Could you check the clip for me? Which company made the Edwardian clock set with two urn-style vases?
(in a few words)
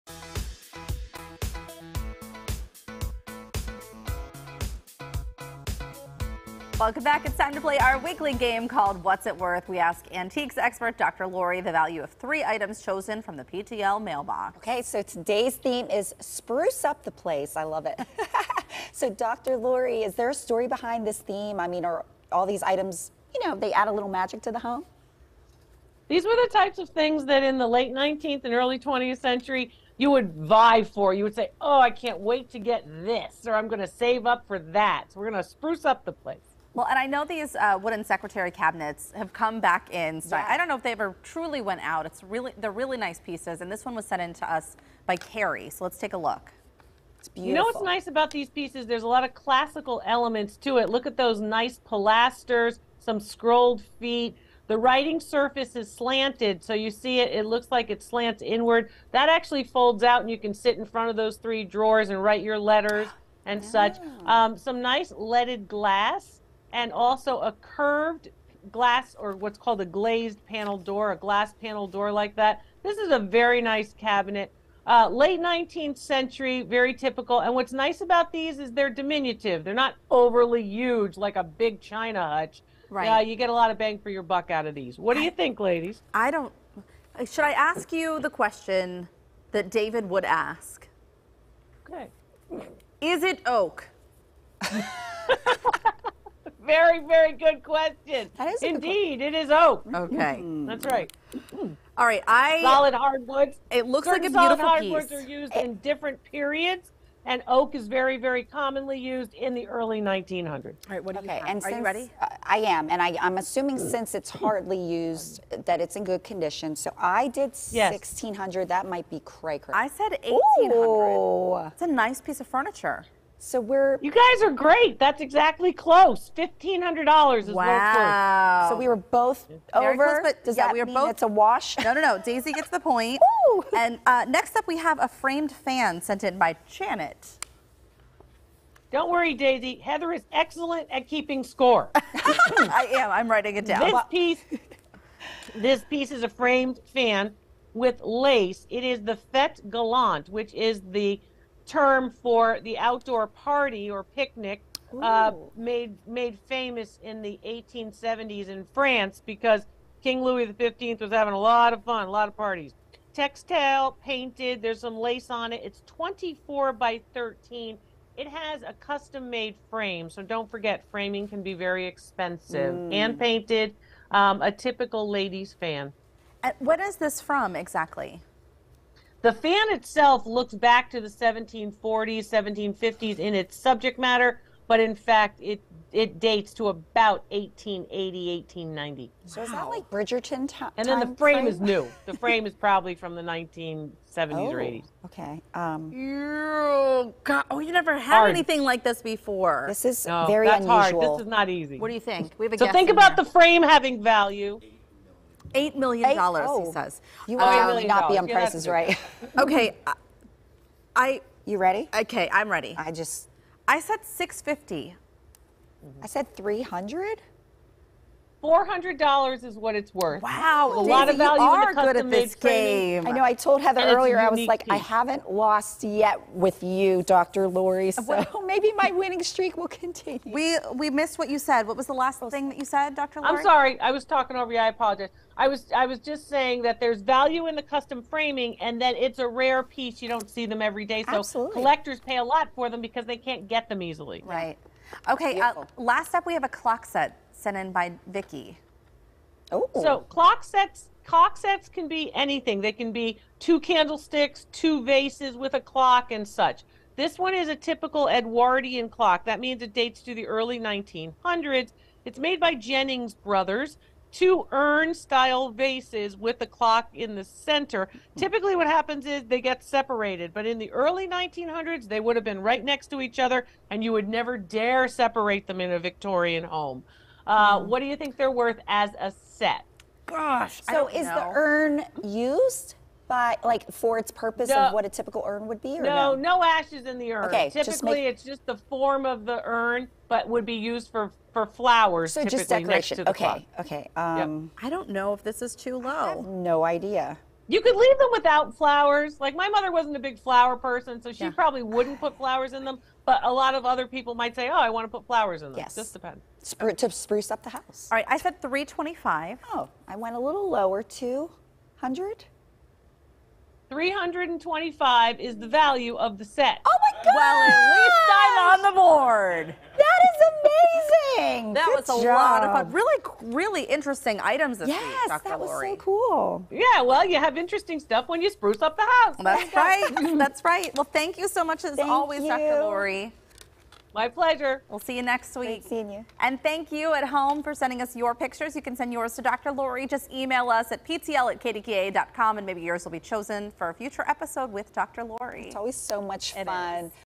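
Jennings Brothers.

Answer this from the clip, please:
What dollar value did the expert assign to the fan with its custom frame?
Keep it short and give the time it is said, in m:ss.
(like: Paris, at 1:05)
$400, at 3:38.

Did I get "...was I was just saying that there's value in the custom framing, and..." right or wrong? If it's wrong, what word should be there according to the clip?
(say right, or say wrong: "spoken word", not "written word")
right.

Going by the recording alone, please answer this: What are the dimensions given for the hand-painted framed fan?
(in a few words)
24 by 13.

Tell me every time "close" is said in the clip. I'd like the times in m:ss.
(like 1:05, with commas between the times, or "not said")
2:05, 2:10.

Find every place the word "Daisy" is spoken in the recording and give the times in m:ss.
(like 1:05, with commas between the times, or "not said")
2:12, 2:19, 3:40.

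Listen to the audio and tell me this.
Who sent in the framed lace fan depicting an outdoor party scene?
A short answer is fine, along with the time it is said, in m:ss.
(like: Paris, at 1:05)
Janet, at 2:16.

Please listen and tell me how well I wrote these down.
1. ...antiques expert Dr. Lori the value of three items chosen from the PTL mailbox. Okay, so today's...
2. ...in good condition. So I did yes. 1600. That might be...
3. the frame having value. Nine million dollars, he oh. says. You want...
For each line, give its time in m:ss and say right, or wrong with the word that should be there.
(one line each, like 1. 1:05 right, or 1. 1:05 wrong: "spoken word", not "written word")
1. 0:10 right
2. 1:55 right
3. 3:23 wrong: "Eight", not "Nine".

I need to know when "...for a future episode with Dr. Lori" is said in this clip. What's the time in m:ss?
5:43.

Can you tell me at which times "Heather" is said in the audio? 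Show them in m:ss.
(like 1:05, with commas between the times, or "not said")
2:19, 3:43.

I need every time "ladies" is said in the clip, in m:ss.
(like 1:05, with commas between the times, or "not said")
1:25, 2:55.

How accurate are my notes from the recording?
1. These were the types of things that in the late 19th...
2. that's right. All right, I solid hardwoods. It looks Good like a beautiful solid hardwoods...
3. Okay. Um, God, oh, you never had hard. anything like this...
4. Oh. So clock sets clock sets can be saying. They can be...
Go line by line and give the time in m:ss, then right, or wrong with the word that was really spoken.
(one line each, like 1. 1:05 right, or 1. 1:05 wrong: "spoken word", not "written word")
1. 0:26 right
2. 1:40 wrong: "Certain", not "Good"
3. 3:15 right
4. 4:09 wrong: "anything", not "saying".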